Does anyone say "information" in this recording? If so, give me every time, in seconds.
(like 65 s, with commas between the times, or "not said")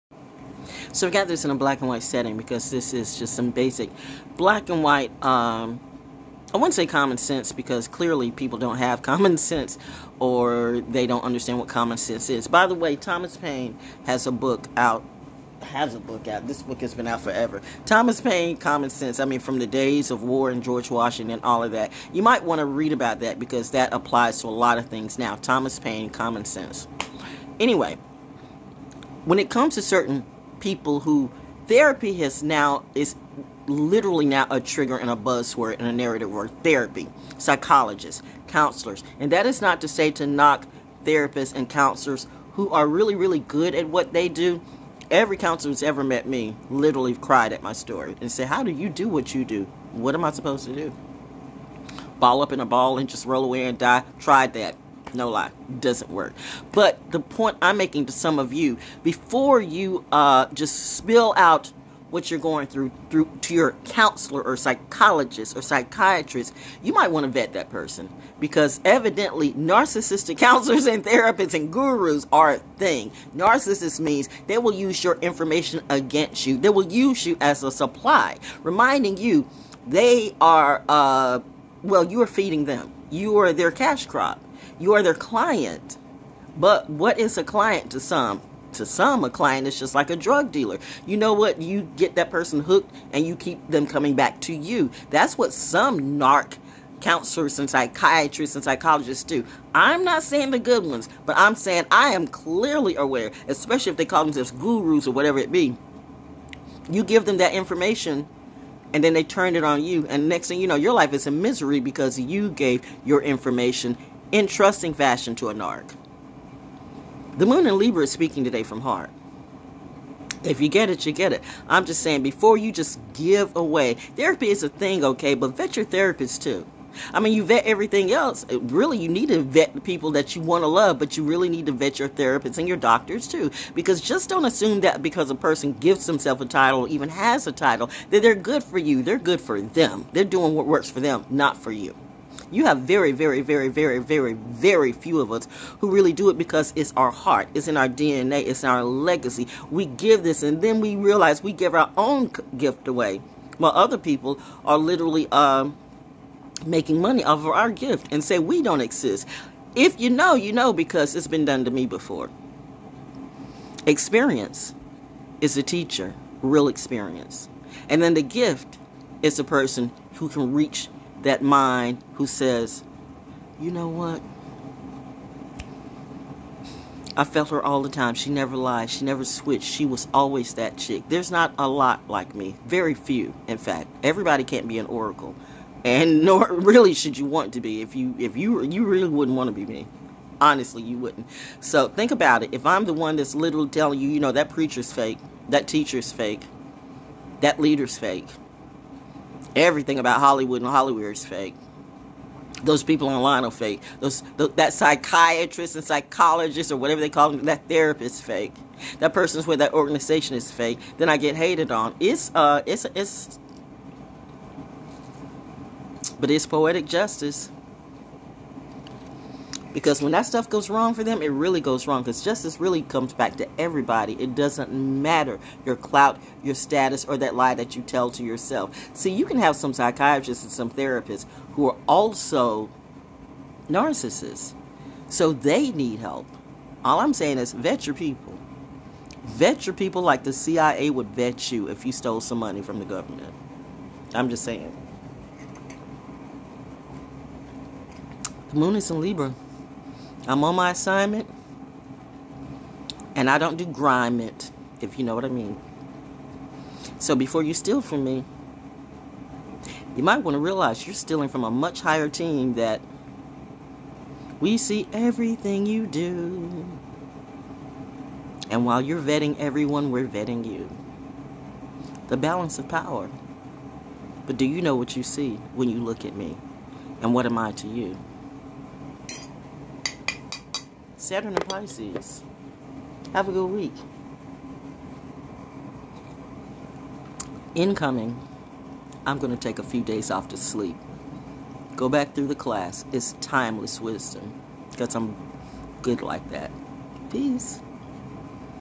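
75 s, 107 s, 113 s.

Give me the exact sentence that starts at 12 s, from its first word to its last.
By the way, Thomas Paine has a book out has a book out.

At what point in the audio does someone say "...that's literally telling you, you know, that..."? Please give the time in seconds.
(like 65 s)
193 s.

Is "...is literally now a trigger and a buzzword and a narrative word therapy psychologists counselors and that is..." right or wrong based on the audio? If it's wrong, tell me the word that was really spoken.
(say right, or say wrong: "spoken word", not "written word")
right.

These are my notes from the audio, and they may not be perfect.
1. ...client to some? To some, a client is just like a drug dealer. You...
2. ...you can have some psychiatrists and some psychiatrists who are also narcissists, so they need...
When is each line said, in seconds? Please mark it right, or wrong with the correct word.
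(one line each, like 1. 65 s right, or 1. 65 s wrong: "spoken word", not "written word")
1. 87 s right
2. 229 s wrong: "therapists", not "psychiatrists".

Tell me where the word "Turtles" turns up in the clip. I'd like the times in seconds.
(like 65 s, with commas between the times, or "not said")
not said.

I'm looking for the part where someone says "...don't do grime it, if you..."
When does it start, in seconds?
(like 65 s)
253 s.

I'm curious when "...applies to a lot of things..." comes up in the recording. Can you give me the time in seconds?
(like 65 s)
23 s.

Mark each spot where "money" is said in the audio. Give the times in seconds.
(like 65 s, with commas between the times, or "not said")
156 s, 242 s.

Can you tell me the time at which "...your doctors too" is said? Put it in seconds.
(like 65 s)
132 s.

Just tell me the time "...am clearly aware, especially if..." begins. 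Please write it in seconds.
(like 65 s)
102 s.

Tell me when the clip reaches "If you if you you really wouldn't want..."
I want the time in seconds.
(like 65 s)
187 s.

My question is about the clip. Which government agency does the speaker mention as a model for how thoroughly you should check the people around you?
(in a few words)
CIA.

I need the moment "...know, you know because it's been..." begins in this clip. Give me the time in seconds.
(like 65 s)
160 s.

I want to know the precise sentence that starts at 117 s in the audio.
The moon in Libra is speaking today from heart.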